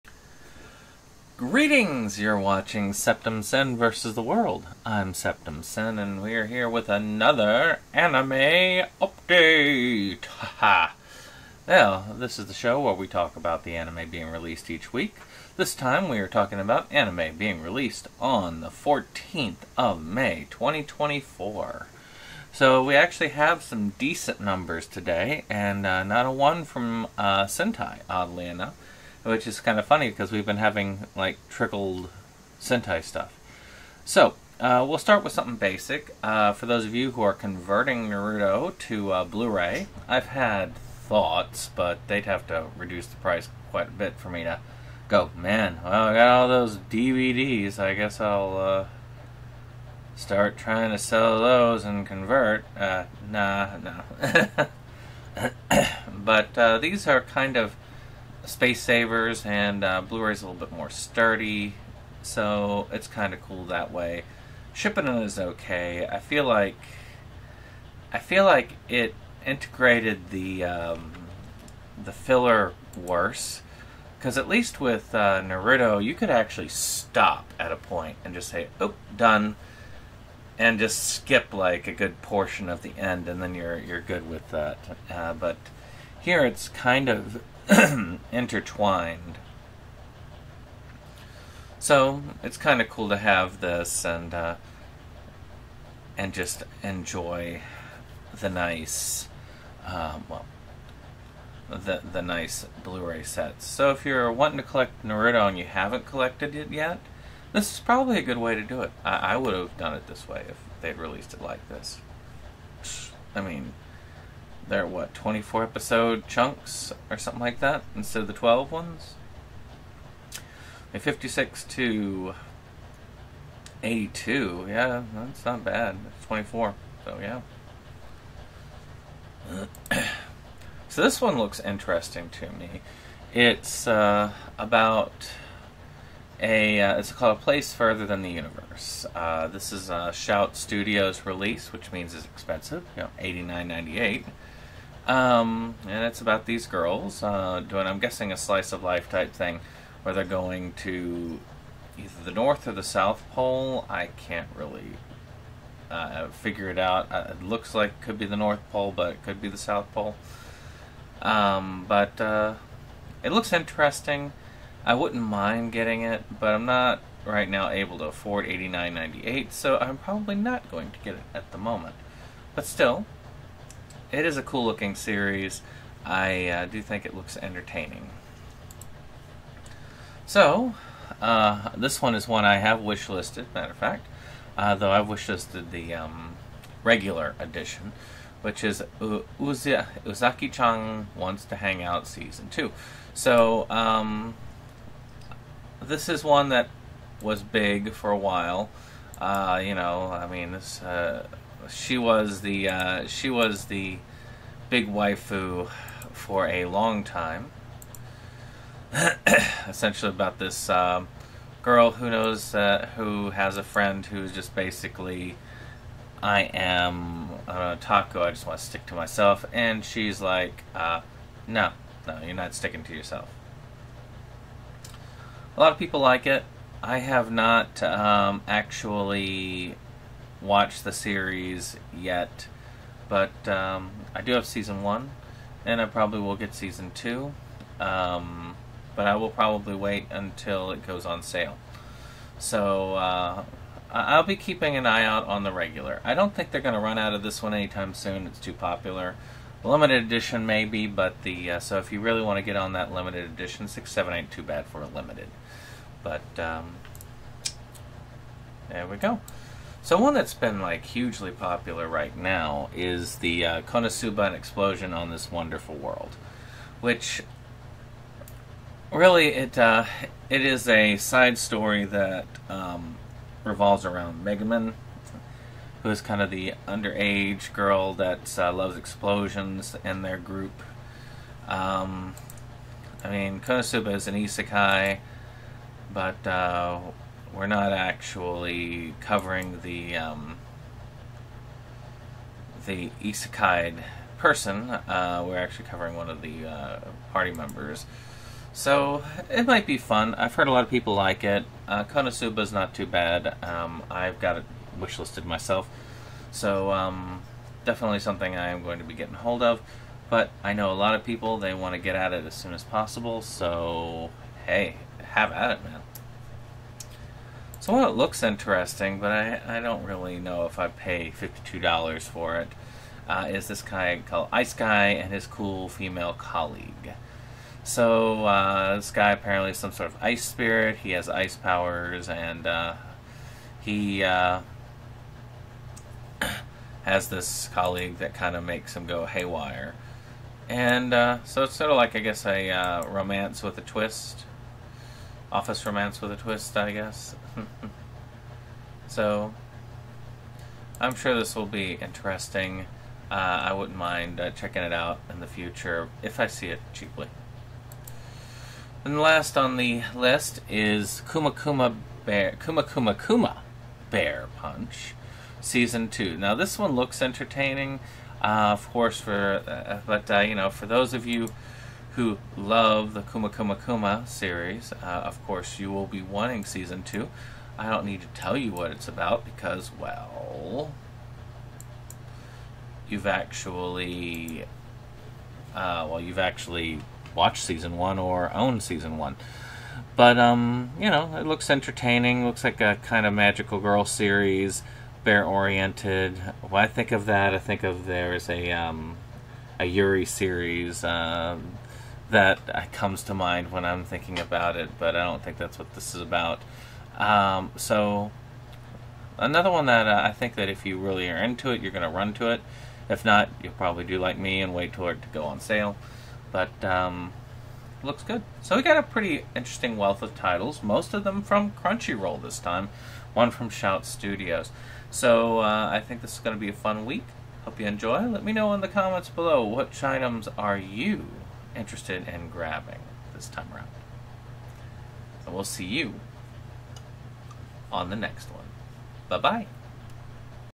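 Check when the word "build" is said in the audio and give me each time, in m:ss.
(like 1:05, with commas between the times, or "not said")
not said.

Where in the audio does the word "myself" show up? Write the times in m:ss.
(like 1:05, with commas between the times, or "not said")
3:38, 5:05.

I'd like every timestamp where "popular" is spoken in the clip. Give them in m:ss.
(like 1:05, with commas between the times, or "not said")
4:08, 4:21.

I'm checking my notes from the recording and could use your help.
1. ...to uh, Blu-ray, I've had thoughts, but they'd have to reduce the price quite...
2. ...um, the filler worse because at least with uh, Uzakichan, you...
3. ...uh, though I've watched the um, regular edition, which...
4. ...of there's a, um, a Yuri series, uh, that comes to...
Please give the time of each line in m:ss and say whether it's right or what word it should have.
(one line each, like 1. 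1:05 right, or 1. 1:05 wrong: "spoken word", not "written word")
1. 0:38 right
2. 1:10 wrong: "Naruto", not "Uzakichan"
3. 3:04 wrong: "wishlisted", not "watched"
4. 6:37 right.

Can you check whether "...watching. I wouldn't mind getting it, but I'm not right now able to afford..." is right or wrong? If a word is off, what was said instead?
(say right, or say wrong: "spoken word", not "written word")
wrong: "interesting", not "watching".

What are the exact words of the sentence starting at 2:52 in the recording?
But still, it is a cool looking series.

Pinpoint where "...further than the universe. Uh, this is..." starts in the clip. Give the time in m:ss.
2:17.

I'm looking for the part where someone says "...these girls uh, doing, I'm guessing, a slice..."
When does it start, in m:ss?
2:26.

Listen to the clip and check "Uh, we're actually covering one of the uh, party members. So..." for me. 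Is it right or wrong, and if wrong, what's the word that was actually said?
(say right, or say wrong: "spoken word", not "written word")
right.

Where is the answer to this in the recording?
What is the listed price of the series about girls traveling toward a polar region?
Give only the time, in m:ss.
2:23.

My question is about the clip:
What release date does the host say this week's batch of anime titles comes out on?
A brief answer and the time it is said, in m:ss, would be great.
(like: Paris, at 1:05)
May 14, 2024, at 0:18.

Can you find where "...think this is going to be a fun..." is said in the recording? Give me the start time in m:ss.
7:05.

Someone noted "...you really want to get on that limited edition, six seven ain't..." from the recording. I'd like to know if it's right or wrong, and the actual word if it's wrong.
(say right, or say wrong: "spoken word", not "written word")
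right.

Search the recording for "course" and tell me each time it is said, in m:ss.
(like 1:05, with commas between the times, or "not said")
6:08, 6:15.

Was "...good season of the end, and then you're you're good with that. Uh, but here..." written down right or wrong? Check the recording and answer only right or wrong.
wrong.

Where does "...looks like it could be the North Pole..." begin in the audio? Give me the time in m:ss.
2:37.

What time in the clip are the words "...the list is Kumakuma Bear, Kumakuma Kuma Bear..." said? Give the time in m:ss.
5:59.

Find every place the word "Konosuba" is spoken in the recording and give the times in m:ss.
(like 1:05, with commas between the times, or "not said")
4:23, 4:43, 5:01.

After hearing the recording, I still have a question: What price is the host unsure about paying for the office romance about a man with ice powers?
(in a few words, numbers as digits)
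$52.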